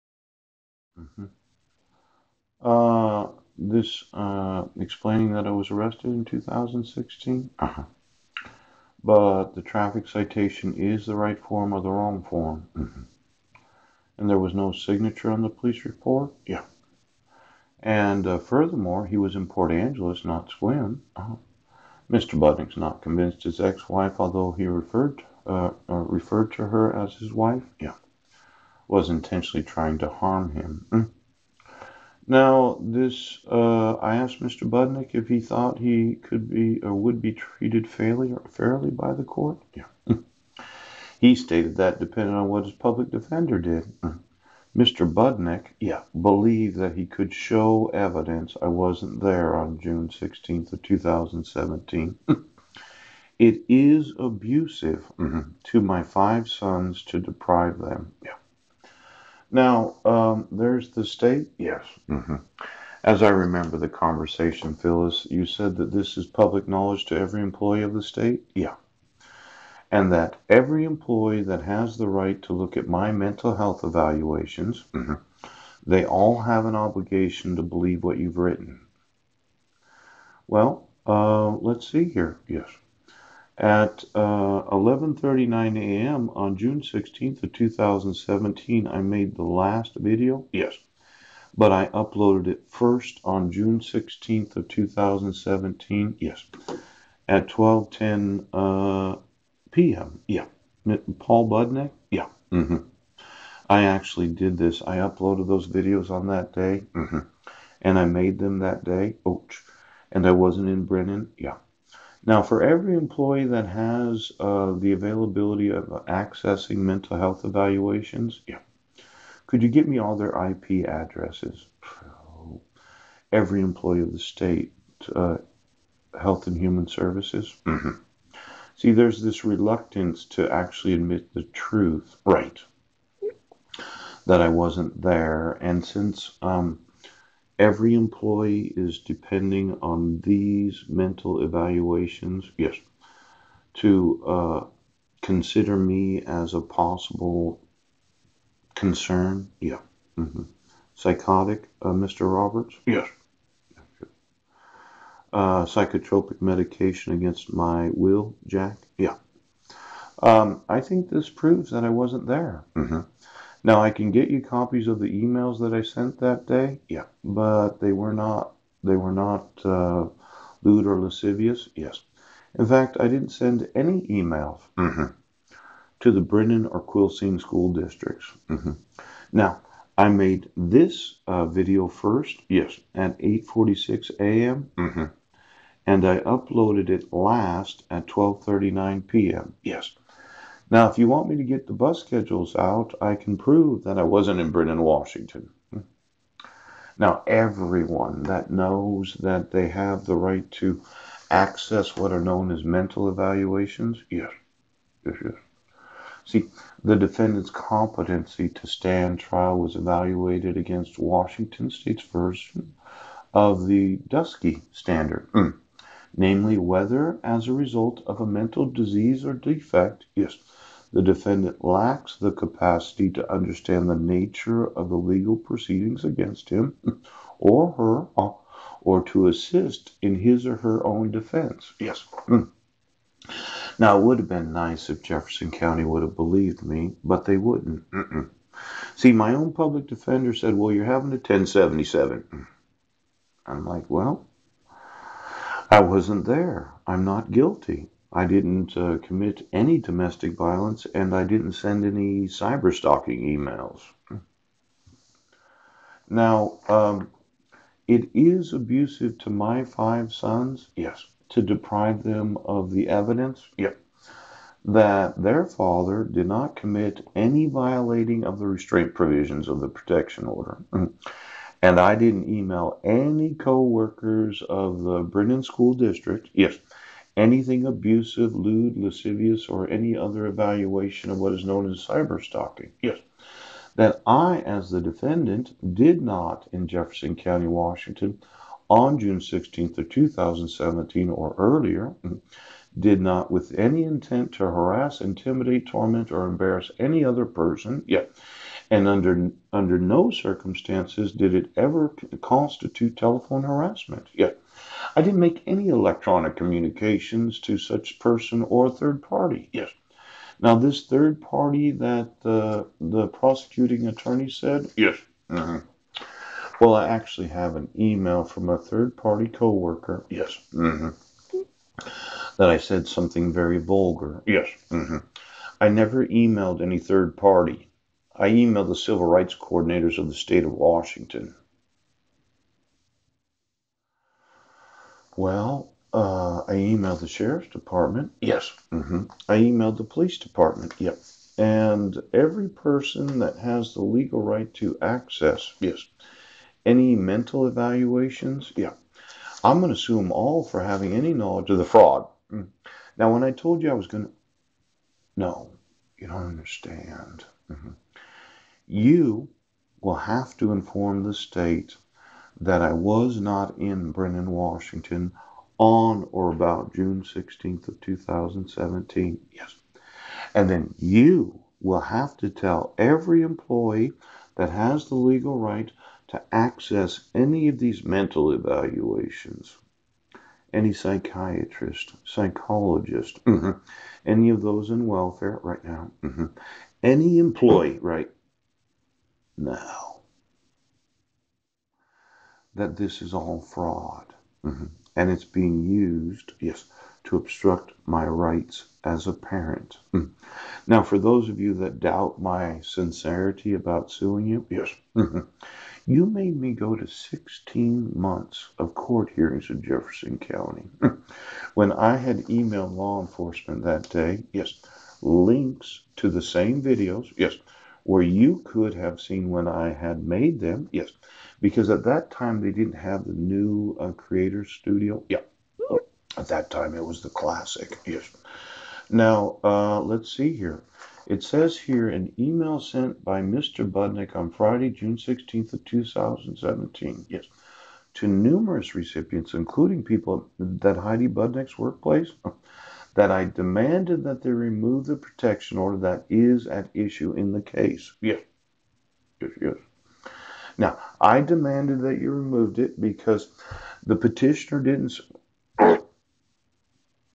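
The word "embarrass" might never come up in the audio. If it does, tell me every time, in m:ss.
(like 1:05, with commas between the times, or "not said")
4:56.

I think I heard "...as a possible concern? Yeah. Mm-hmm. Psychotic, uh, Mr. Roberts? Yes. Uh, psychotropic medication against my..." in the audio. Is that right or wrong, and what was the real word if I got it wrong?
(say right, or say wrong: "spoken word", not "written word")
right.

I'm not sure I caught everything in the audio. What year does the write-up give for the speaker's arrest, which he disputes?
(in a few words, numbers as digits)
2016.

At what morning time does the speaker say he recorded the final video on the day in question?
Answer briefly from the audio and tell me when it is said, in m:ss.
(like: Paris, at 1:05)
11:39 a.m., at 1:24.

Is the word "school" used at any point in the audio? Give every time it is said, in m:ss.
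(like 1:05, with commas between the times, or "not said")
2:57, 4:35.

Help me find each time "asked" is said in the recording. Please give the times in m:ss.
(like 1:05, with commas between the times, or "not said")
0:34.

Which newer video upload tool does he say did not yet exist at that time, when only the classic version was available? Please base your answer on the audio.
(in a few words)
Creator Studio.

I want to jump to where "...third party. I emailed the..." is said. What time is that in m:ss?
5:26.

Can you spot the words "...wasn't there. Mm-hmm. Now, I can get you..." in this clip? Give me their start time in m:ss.
2:41.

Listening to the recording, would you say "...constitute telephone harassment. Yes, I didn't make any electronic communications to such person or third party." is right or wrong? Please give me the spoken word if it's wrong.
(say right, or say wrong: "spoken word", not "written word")
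right.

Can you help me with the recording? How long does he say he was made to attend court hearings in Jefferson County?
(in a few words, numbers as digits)
16 months.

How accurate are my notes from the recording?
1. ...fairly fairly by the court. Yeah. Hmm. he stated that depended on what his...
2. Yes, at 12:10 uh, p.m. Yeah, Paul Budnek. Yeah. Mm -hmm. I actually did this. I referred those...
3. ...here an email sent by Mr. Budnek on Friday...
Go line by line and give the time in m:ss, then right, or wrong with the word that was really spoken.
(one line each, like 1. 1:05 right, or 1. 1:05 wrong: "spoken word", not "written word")
1. 0:37 right
2. 1:36 wrong: "uploaded", not "referred"
3. 7:11 right.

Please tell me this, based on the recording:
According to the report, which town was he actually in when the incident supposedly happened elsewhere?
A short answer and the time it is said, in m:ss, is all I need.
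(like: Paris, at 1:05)
Port Angeles, at 0:19.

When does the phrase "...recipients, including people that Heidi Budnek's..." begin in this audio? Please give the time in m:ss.
7:18.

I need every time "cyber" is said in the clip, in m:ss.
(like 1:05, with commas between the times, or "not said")
4:12, 4:41.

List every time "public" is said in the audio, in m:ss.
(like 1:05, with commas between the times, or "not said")
0:42, 1:06, 3:59.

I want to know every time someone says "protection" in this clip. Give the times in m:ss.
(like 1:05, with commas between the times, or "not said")
4:29, 7:24.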